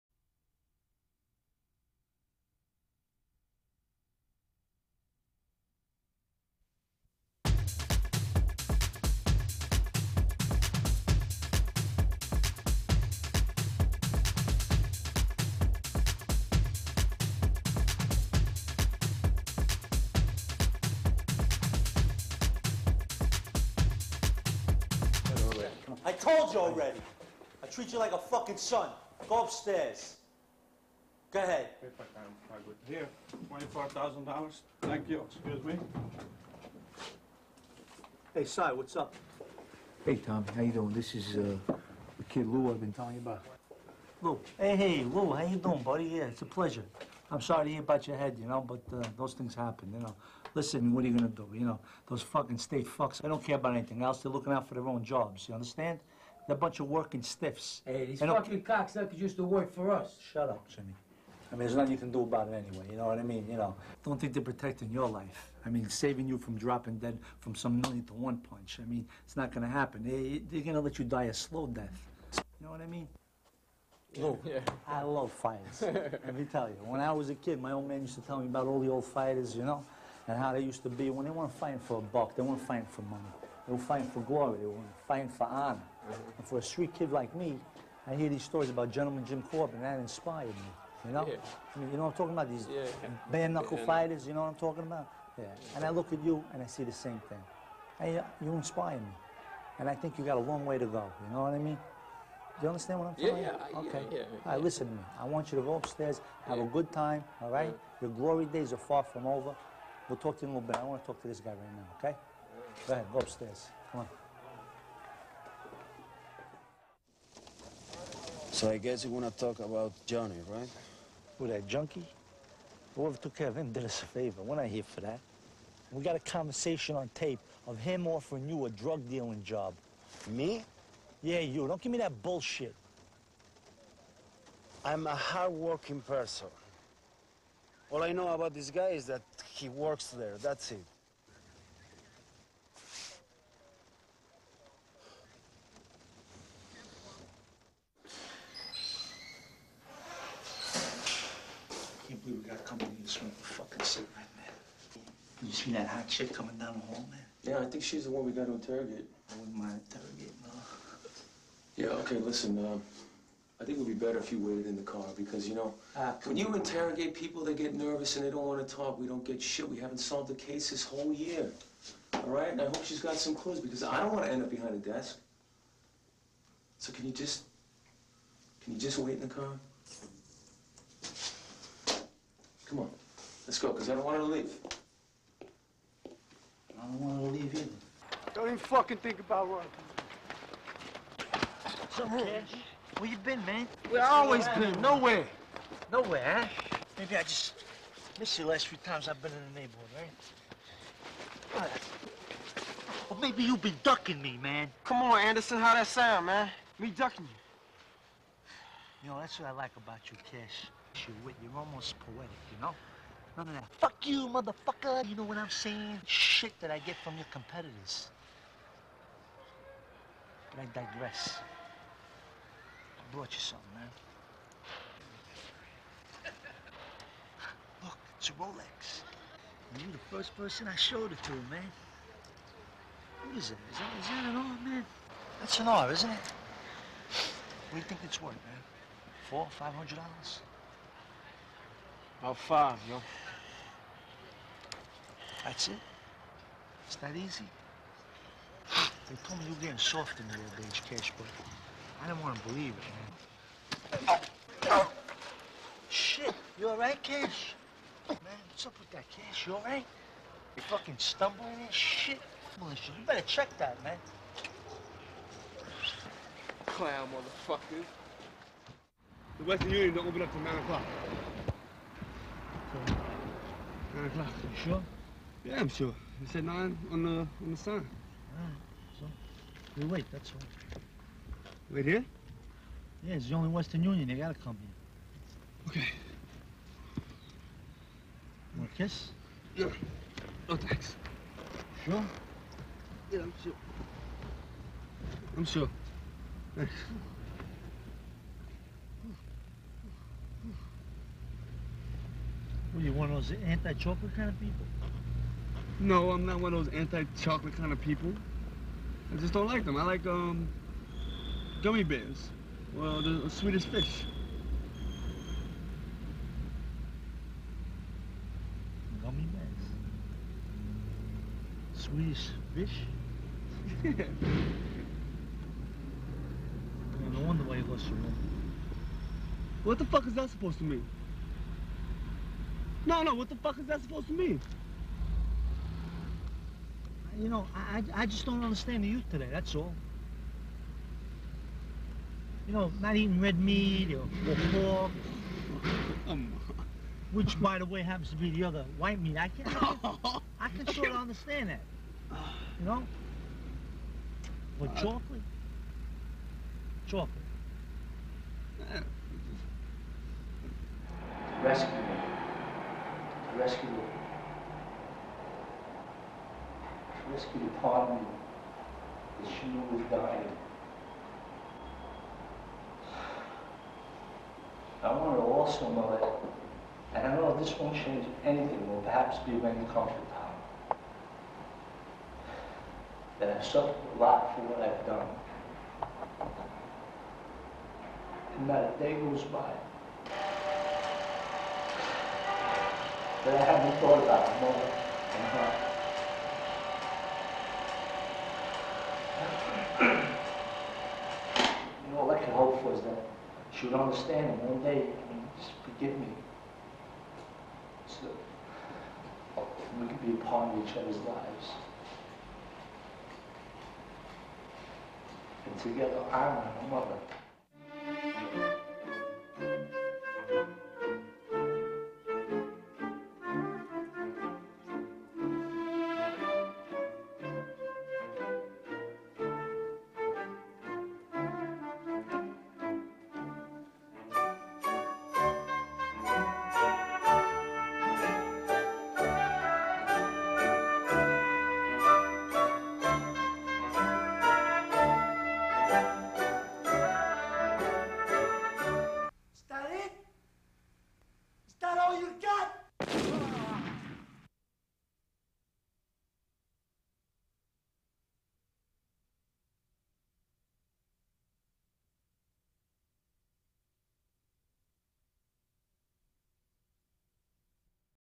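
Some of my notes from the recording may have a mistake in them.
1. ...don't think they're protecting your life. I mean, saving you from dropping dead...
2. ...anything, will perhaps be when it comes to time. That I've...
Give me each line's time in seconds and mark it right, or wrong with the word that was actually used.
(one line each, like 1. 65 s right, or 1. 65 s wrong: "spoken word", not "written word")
1. 64 s right
2. 378 s right.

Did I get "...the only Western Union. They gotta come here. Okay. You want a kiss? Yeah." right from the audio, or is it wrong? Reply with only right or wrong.
right.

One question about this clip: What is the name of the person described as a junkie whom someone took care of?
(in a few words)
Johnny.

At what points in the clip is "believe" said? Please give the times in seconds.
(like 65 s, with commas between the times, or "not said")
152 s, 252 s.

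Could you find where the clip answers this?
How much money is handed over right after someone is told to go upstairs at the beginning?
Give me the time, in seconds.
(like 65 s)
33 s.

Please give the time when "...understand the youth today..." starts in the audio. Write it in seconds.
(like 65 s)
338 s.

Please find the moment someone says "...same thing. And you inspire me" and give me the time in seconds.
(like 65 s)
96 s.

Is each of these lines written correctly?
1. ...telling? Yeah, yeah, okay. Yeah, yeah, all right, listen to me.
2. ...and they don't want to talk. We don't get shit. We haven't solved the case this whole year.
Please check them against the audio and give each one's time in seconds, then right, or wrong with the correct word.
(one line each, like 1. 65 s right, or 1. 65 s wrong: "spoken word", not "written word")
1. 103 s wrong: "saying", not "telling"
2. 168 s right.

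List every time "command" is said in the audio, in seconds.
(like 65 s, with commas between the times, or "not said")
not said.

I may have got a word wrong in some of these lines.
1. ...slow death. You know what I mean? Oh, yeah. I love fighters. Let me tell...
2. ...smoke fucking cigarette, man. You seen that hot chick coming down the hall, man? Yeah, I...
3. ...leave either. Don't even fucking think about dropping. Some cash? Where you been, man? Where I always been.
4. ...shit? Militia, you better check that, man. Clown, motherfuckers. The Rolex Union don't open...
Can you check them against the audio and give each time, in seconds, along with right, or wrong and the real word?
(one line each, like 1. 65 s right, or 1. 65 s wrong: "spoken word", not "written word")
1. 71 s right
2. 153 s right
3. 187 s wrong: "running", not "dropping"
4. 261 s wrong: "Western", not "Rolex".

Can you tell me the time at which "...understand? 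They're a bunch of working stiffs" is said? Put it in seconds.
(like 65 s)
55 s.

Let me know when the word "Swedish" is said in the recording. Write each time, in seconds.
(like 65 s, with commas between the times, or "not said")
313 s, 321 s.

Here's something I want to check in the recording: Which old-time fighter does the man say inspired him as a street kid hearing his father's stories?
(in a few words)
Gentleman Jim Corbett.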